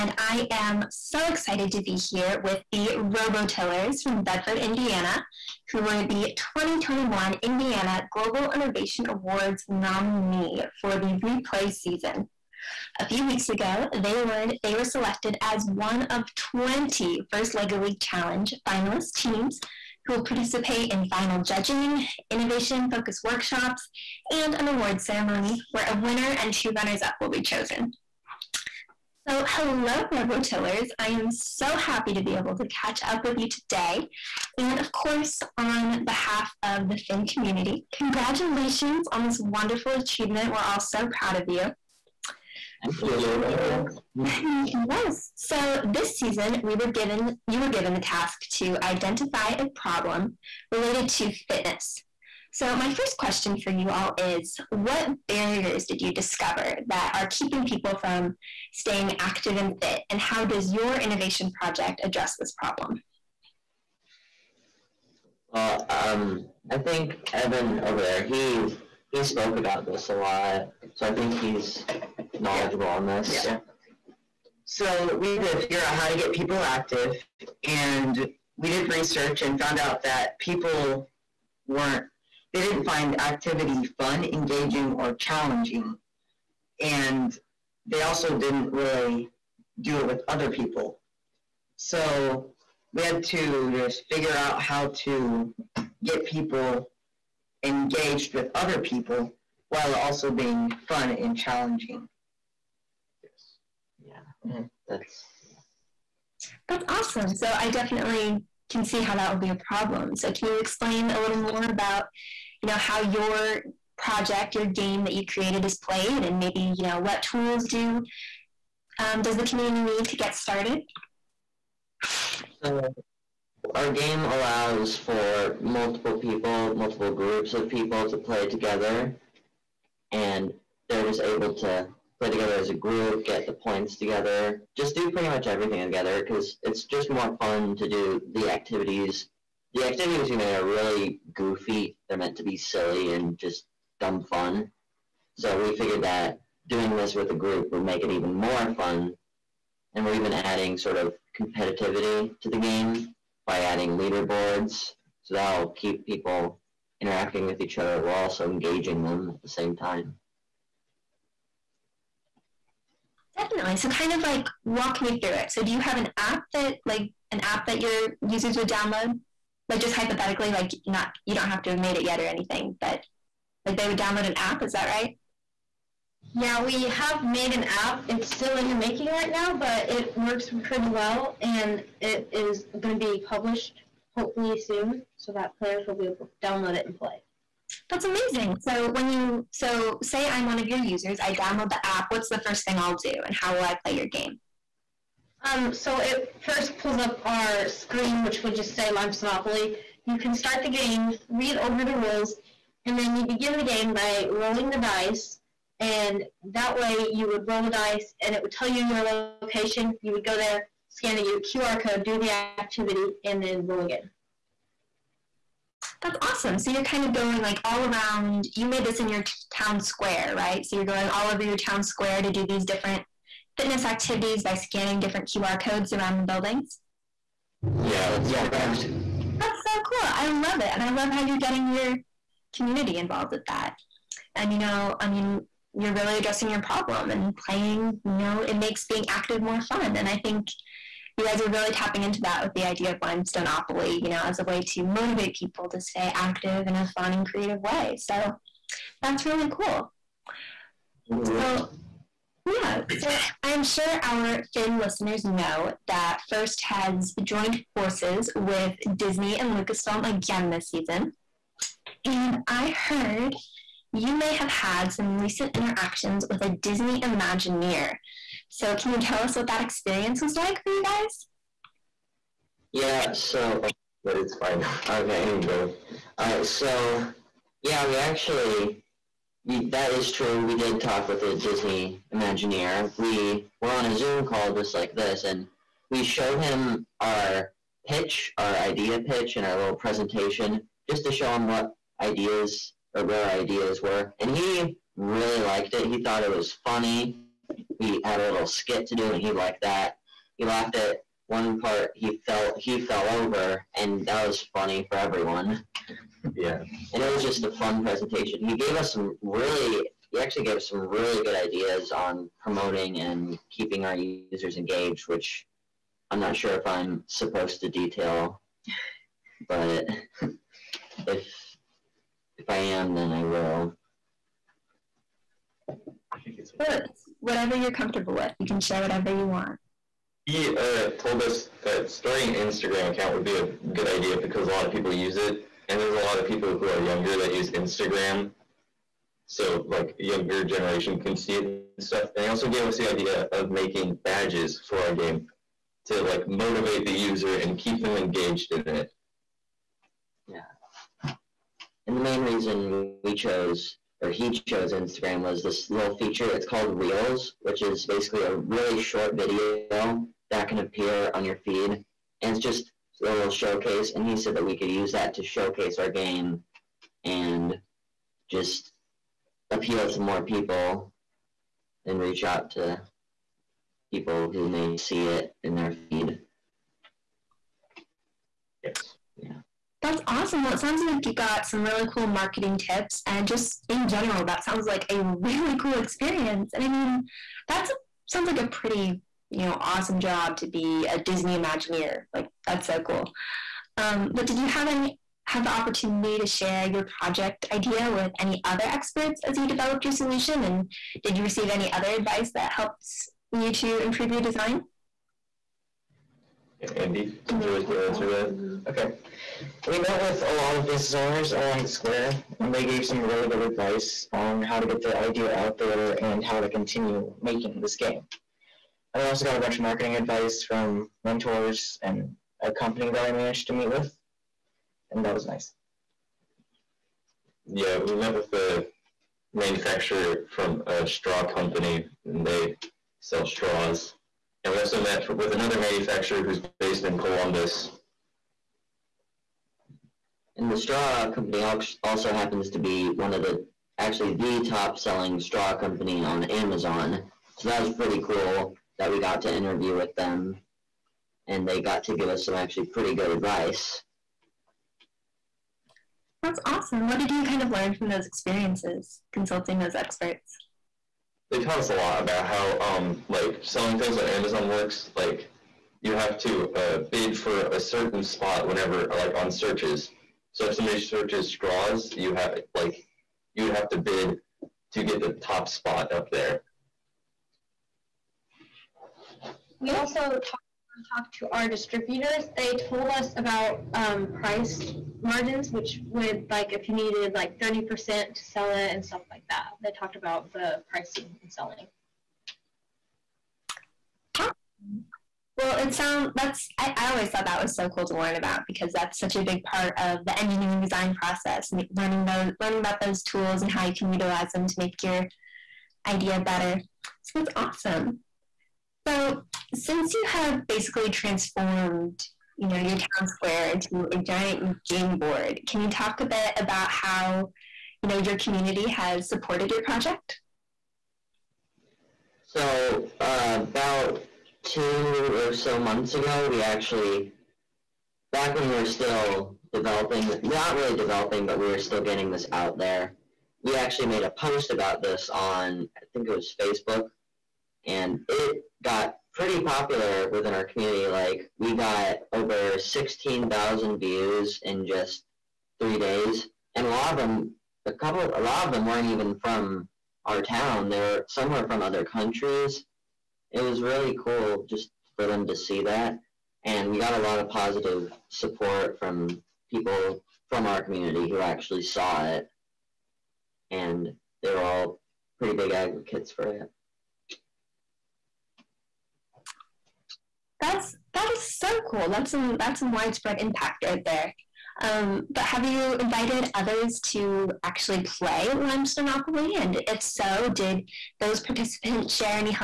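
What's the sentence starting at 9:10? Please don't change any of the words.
They were somewhere from other countries it was really cool just for them to see that.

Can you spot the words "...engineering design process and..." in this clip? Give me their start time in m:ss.
8:20.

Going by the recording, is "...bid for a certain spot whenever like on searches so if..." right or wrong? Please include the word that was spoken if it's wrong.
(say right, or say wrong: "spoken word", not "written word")
right.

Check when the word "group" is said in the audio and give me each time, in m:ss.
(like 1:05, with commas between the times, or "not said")
2:07, 2:12, 2:27.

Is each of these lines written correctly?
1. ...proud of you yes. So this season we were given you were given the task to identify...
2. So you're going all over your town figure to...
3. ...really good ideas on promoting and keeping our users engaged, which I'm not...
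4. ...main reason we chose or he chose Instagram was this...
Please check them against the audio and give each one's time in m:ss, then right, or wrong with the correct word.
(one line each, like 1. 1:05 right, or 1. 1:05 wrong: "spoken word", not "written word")
1. 0:41 right
2. 3:40 wrong: "square", not "figure"
3. 5:10 right
4. 5:52 right.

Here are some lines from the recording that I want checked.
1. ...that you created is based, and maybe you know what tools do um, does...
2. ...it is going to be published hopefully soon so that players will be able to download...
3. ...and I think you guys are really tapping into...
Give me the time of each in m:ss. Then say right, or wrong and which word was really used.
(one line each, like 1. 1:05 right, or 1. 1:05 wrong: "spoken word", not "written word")
1. 1:55 wrong: "played", not "based"
2. 3:02 right
3. 3:59 right.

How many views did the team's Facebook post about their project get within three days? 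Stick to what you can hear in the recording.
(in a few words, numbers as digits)
16,000.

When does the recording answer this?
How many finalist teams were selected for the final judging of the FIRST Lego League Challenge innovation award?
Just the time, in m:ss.
0:16.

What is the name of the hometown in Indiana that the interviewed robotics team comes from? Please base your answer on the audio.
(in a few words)
Bedford.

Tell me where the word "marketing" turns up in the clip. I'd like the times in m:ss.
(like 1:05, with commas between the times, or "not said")
6:22, 6:59.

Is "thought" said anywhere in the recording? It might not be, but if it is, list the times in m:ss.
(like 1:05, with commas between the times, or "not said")
4:56, 8:17.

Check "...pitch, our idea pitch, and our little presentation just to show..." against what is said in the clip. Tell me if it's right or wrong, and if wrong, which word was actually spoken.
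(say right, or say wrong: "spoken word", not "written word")
right.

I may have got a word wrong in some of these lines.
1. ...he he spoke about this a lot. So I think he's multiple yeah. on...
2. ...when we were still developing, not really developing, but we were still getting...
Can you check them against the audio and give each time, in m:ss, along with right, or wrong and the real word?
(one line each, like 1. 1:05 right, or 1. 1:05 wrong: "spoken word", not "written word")
1. 1:08 wrong: "knowledgeable", not "multiple"
2. 8:48 right.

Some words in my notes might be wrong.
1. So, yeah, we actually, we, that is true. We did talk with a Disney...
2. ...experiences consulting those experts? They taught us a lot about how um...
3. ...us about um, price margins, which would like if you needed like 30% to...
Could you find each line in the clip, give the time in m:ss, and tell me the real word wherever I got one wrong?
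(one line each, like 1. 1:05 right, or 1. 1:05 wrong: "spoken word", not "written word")
1. 4:36 right
2. 7:38 right
3. 8:02 right.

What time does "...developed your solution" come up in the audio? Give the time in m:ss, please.
6:39.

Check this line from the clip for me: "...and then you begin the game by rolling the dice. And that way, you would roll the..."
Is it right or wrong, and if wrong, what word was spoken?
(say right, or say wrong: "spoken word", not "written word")
right.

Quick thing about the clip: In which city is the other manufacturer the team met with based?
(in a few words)
Columbus.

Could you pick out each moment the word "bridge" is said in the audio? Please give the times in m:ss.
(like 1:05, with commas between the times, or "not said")
not said.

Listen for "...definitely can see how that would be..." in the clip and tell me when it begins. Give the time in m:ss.
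1:47.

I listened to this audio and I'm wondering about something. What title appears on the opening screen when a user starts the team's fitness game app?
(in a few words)
Lime Monopoly.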